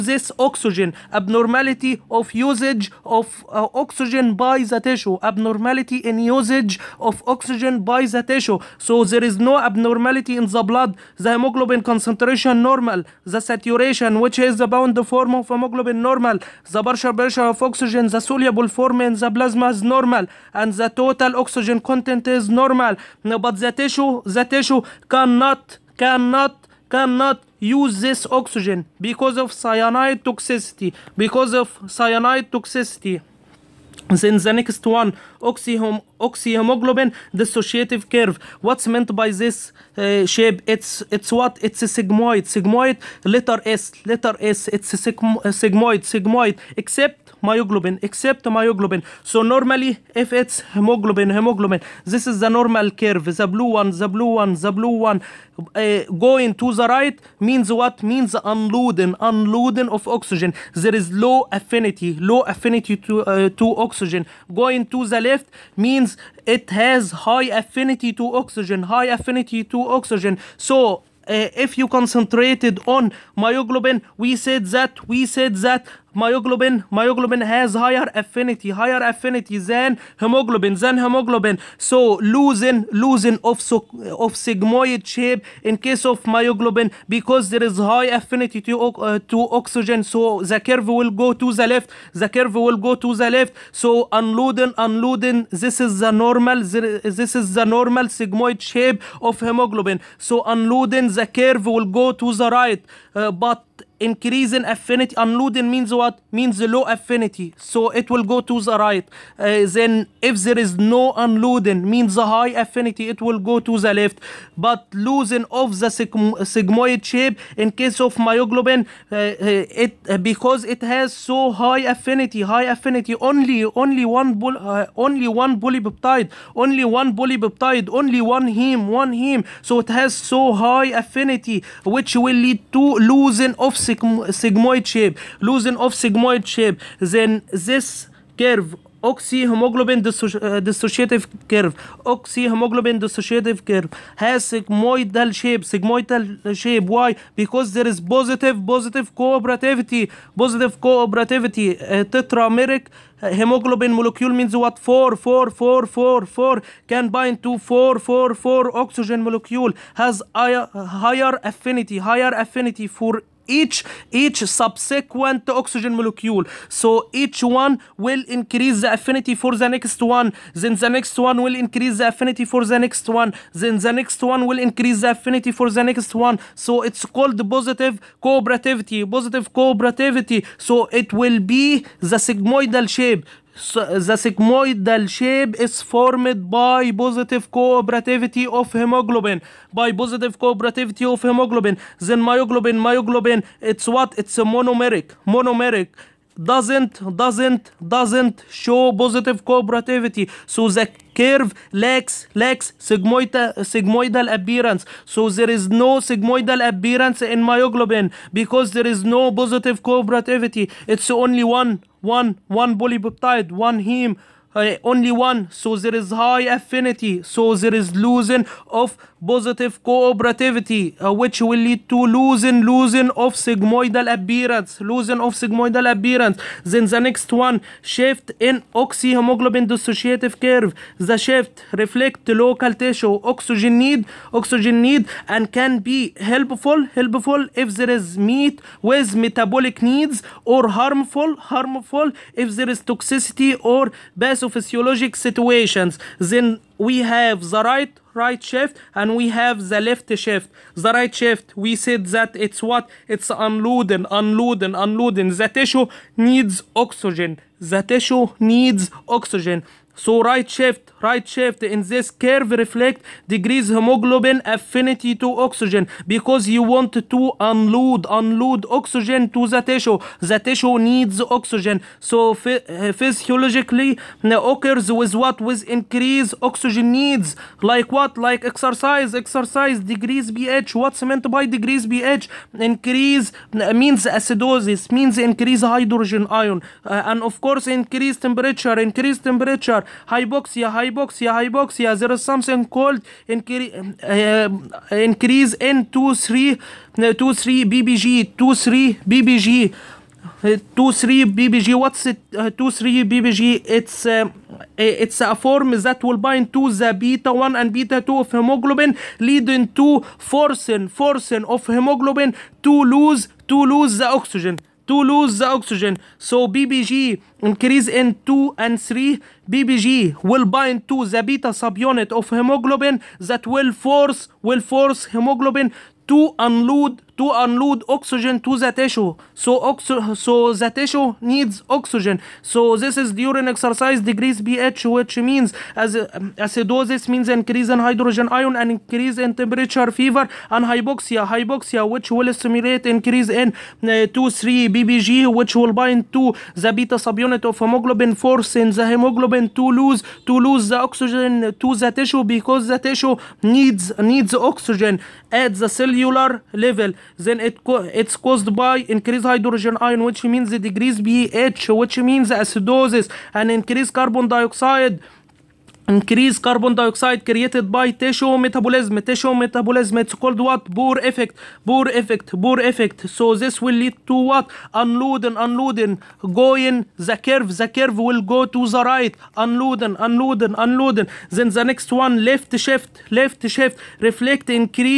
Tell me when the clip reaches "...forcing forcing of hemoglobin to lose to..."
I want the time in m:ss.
5:10.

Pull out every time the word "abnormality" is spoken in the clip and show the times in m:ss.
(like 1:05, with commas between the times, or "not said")
0:01, 0:05, 0:09.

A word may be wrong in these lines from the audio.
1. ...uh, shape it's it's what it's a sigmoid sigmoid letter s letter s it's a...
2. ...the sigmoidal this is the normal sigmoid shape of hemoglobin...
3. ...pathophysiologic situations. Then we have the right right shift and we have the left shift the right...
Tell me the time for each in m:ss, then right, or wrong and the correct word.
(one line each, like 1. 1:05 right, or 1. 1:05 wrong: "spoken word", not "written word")
1. 0:39 right
2. 1:35 wrong: "normal", not "sigmoidal"
3. 4:04 right.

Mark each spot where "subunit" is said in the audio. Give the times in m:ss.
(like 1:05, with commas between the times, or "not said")
5:21, 5:47.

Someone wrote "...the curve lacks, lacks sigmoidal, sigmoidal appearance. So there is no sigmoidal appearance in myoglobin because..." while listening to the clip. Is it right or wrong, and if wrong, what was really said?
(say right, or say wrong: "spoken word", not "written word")
right.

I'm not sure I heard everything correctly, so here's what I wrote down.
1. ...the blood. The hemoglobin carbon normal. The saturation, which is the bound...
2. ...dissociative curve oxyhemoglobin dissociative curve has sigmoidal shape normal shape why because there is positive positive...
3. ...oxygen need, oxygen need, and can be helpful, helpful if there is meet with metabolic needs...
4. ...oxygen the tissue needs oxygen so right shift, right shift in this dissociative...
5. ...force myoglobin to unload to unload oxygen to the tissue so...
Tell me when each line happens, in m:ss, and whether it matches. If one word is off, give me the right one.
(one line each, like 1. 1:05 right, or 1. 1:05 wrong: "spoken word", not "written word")
1. 0:10 wrong: "concentration", not "carbon"
2. 2:20 wrong: "sigmoidal", not "normal"
3. 3:53 right
4. 4:16 wrong: "curve", not "dissociative"
5. 5:24 wrong: "hemoglobin", not "myoglobin".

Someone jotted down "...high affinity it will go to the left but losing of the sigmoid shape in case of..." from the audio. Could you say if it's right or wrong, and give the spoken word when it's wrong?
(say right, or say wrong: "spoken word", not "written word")
right.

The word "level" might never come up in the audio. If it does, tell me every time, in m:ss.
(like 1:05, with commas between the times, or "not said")
5:56.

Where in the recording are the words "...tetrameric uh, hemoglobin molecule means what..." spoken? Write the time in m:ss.
2:32.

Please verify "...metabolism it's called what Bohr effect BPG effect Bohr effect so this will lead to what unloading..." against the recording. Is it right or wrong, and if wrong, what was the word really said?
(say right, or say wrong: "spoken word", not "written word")
wrong: "Bohr", not "BPG".